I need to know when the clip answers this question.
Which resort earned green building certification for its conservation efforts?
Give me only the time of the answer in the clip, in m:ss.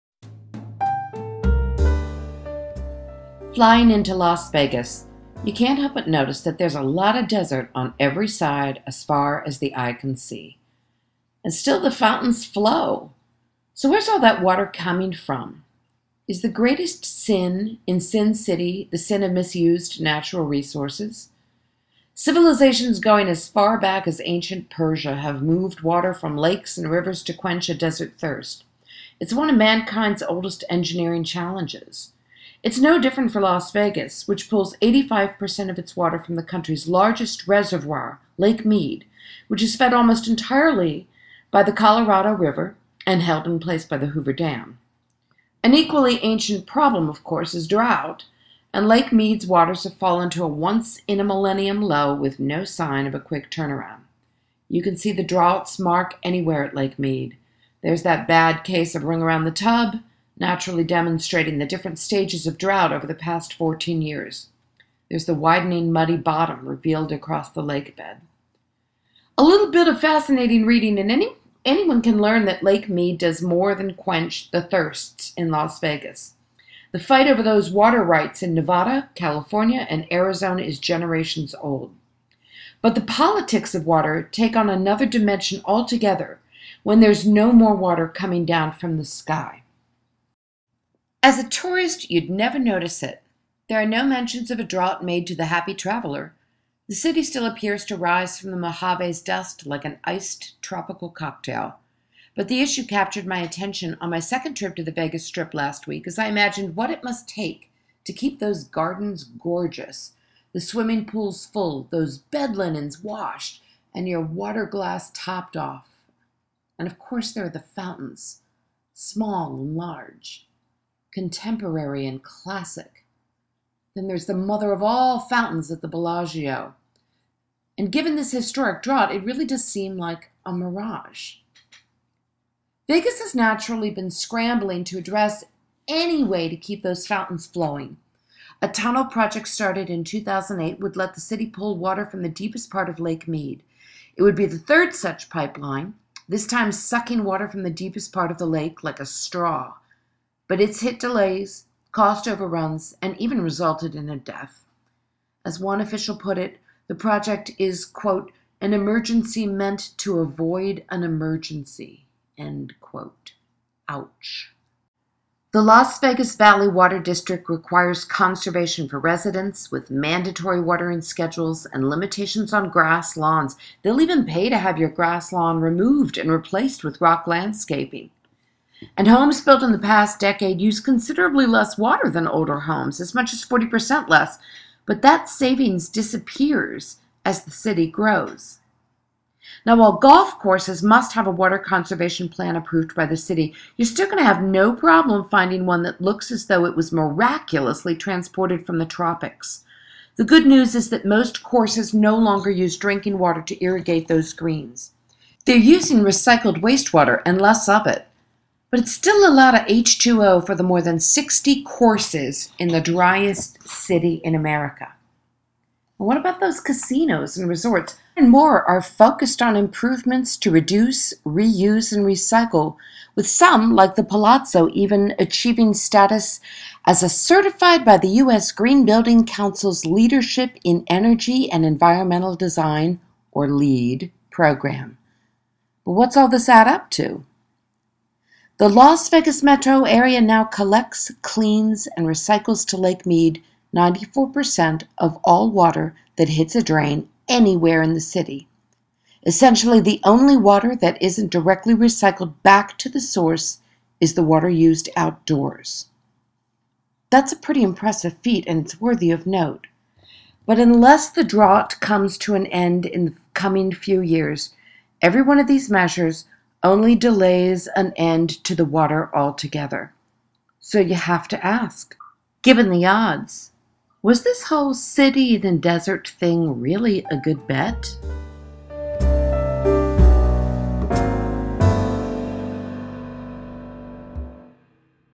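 3:43.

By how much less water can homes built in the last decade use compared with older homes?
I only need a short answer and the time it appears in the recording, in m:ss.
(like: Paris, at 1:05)
40%, at 3:03.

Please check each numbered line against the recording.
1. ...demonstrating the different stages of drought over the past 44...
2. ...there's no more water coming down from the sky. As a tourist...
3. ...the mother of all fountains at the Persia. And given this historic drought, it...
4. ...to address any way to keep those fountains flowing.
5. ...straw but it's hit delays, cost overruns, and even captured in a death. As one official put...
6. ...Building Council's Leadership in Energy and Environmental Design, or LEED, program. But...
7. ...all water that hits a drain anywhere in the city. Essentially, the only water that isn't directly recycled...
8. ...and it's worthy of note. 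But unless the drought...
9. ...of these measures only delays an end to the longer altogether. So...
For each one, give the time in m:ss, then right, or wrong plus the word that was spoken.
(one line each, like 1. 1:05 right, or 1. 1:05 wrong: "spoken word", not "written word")
1. 1:00 wrong: "14", not "44"
2. 1:26 right
3. 2:04 wrong: "Bellagio", not "Persia"
4. 2:14 right
5. 2:29 wrong: "resulted", not "captured"
6. 3:48 right
7. 4:05 right
8. 4:18 right
9. 4:25 wrong: "water", not "longer".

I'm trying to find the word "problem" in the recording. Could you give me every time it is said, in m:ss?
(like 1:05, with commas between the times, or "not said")
0:46, 3:14.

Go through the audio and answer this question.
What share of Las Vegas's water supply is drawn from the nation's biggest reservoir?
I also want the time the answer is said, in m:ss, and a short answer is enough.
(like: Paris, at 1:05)
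85%, at 0:34.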